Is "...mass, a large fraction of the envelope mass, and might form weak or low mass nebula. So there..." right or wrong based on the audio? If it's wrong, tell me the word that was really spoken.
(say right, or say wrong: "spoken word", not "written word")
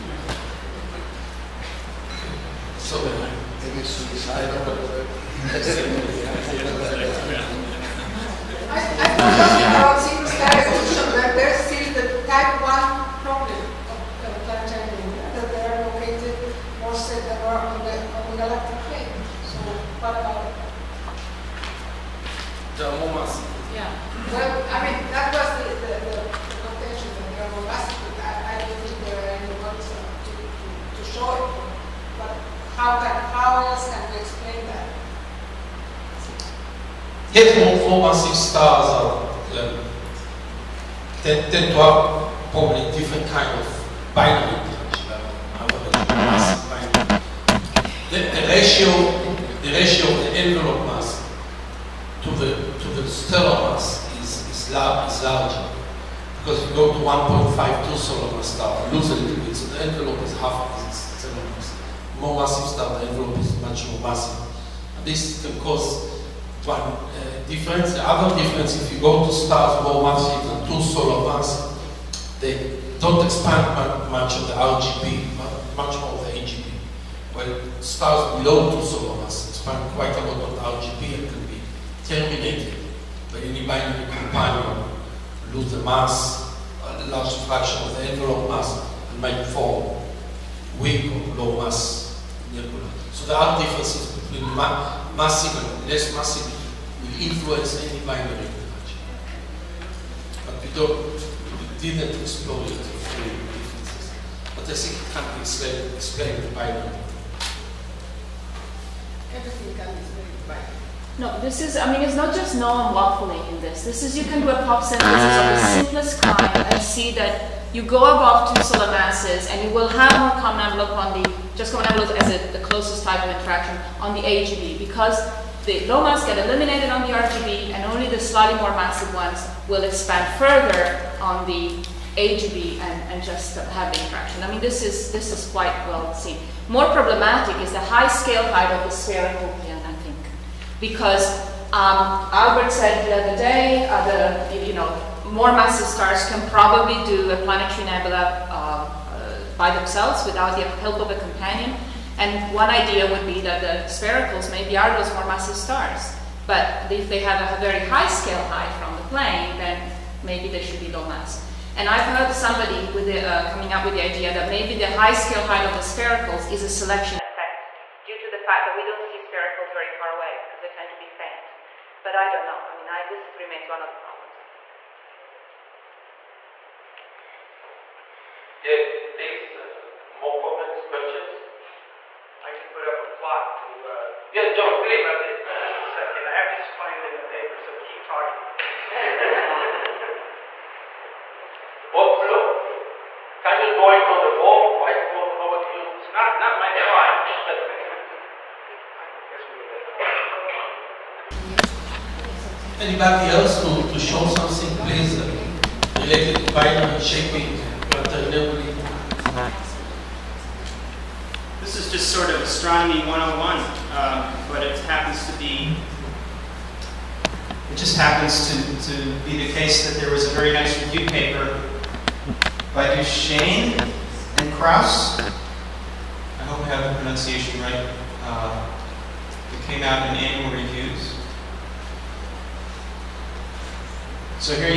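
right.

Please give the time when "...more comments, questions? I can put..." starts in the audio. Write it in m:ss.
3:00.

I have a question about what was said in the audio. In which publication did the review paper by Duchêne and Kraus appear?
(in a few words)
Annual Reviews.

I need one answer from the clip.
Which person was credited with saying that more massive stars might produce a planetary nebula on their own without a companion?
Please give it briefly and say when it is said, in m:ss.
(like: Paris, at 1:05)
Albert, at 2:22.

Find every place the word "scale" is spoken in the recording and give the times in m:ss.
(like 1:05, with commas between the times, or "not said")
2:18, 2:38, 2:45.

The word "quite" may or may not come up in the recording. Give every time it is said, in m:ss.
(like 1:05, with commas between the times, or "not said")
1:19, 2:15.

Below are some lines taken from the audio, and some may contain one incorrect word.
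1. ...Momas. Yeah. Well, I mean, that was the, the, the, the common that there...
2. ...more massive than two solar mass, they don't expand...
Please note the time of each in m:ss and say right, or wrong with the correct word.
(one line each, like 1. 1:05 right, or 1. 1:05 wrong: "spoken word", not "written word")
1. 0:23 wrong: "contention", not "common"
2. 1:09 right.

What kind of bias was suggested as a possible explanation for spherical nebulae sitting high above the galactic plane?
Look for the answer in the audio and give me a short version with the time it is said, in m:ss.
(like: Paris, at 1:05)
selection effect, at 2:46.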